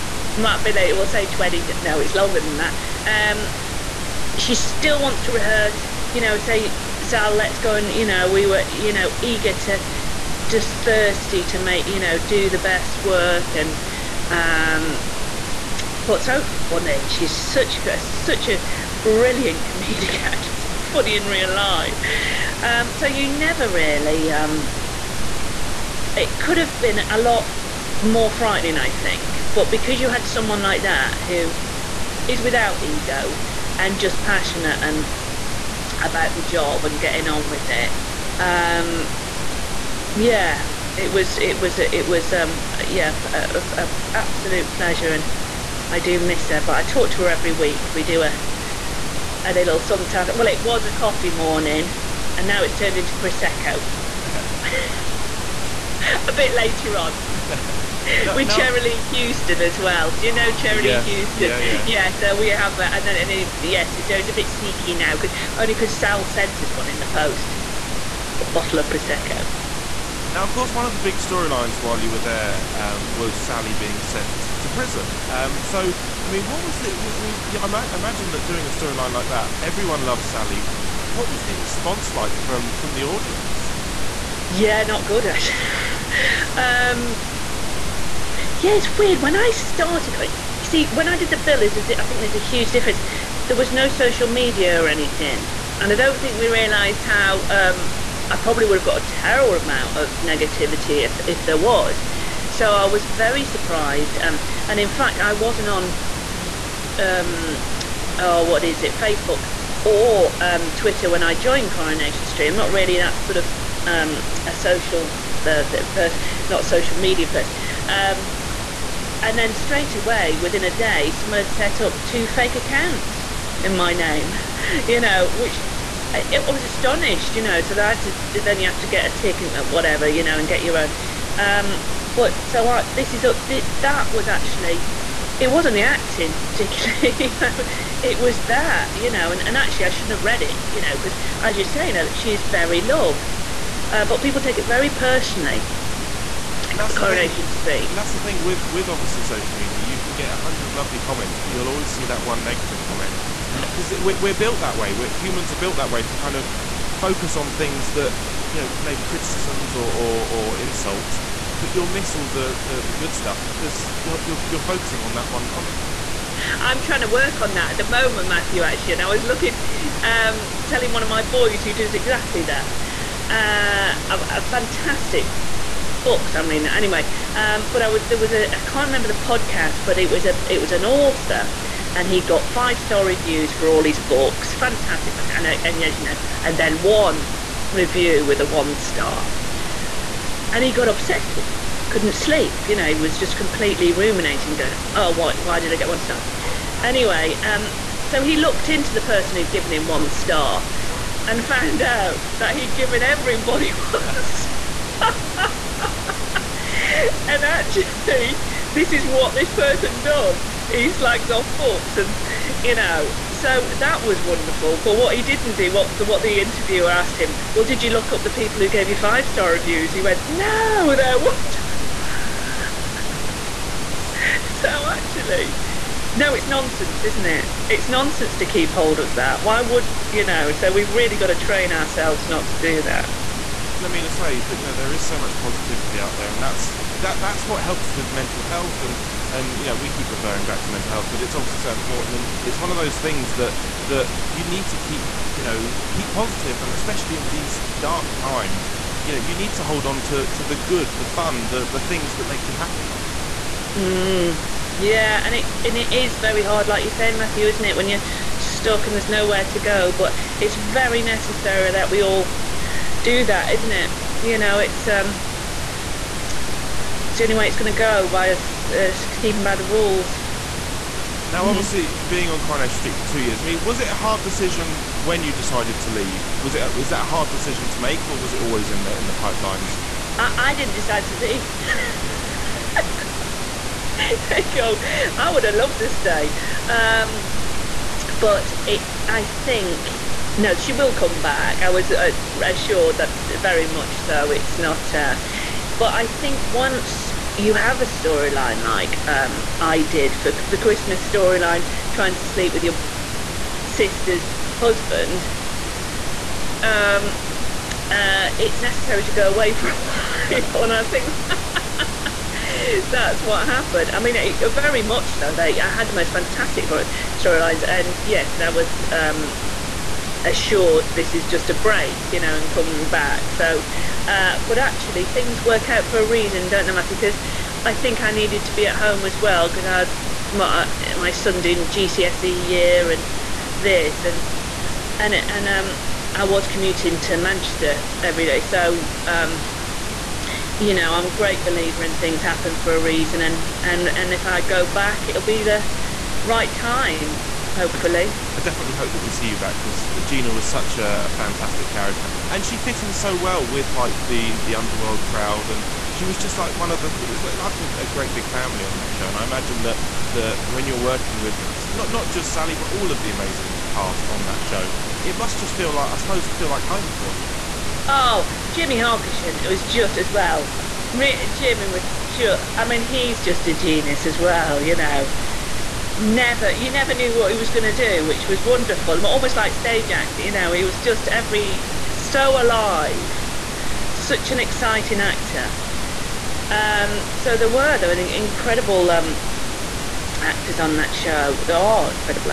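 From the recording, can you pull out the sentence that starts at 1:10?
Now, of course, one of the big storylines while you were there um, was Sally being sent to prison.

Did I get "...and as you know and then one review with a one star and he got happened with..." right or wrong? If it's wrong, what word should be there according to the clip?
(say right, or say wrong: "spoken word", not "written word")
wrong: "obsessed", not "happened".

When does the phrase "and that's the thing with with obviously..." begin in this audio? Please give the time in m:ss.
2:27.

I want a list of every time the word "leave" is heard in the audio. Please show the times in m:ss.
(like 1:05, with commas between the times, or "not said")
4:35, 4:41.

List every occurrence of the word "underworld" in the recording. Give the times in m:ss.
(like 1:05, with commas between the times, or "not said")
5:54.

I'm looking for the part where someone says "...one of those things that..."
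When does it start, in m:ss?
4:02.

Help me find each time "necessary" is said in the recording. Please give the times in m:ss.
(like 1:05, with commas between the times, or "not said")
4:21, 5:08.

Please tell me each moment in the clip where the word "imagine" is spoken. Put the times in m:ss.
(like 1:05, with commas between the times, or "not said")
1:17, 5:59.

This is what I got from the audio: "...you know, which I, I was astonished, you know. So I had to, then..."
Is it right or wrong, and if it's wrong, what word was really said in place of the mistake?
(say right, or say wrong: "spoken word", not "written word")
right.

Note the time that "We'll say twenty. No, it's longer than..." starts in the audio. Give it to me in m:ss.
0:00.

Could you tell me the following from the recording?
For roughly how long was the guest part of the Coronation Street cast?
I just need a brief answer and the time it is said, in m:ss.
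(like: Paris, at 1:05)
2 years, at 4:33.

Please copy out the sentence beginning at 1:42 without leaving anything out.
So I was very surprised, um, and in fact, I wasn't on.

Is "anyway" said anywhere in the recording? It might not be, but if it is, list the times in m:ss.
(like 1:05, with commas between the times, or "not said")
2:56, 3:16.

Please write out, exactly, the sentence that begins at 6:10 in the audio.
Jimmi was just, I mean, he's just a genius as well, you know.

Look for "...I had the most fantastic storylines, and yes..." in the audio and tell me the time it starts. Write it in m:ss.
5:15.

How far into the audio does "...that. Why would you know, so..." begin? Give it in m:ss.
3:49.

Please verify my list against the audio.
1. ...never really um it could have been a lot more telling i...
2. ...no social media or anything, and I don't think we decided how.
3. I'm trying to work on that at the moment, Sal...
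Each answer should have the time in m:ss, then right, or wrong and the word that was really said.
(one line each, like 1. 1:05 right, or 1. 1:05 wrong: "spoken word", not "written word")
1. 0:23 wrong: "frightening", not "telling"
2. 1:33 wrong: "realised", not "decided"
3. 2:46 wrong: "Matthew", not "Sal".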